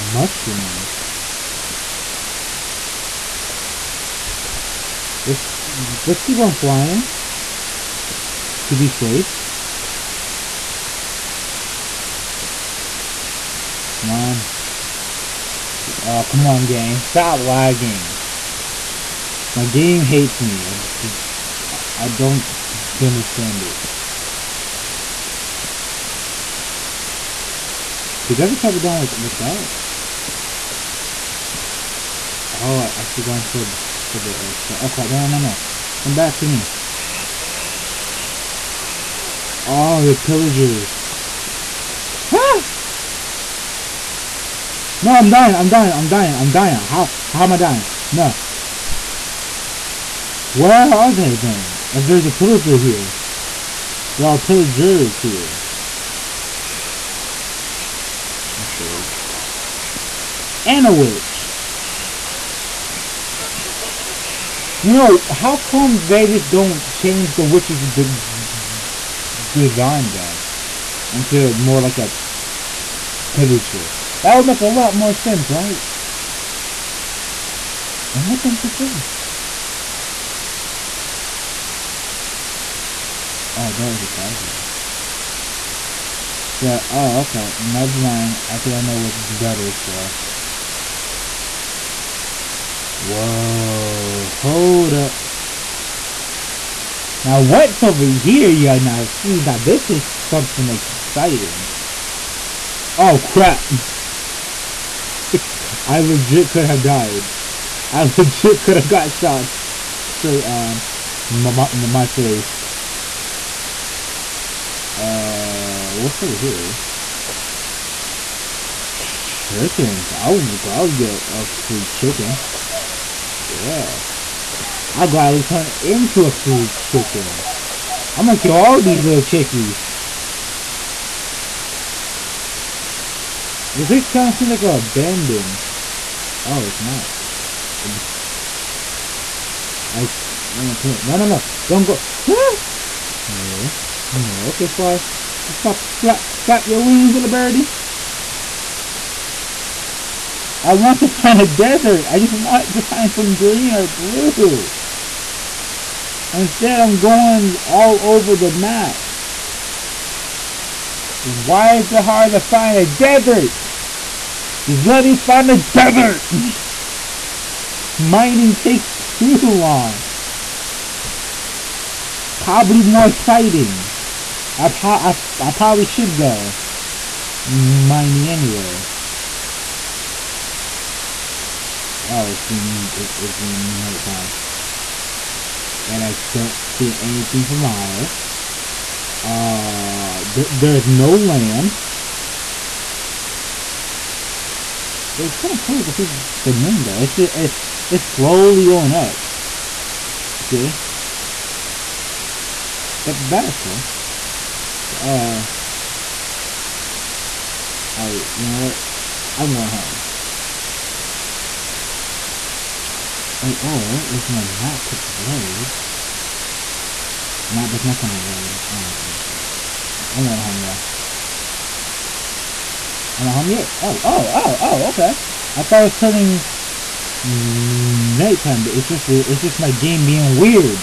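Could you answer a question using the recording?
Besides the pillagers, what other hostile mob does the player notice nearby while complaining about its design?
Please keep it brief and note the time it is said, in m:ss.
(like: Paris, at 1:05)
A witch, at 1:00.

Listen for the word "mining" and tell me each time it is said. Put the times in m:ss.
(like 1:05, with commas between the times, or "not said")
2:47, 2:57.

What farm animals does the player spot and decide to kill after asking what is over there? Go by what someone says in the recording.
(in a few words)
Chickens.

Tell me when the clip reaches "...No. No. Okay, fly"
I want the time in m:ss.
2:23.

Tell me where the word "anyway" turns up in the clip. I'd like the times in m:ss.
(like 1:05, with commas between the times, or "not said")
2:58.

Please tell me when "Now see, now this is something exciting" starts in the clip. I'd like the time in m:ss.
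1:38.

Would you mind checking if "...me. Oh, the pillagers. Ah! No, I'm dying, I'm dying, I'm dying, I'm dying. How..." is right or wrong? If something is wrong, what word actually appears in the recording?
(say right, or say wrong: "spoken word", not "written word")
right.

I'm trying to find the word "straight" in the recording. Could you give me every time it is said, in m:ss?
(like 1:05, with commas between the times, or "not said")
1:49.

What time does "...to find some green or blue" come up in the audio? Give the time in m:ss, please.
2:32.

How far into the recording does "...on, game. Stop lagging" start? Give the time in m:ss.
0:16.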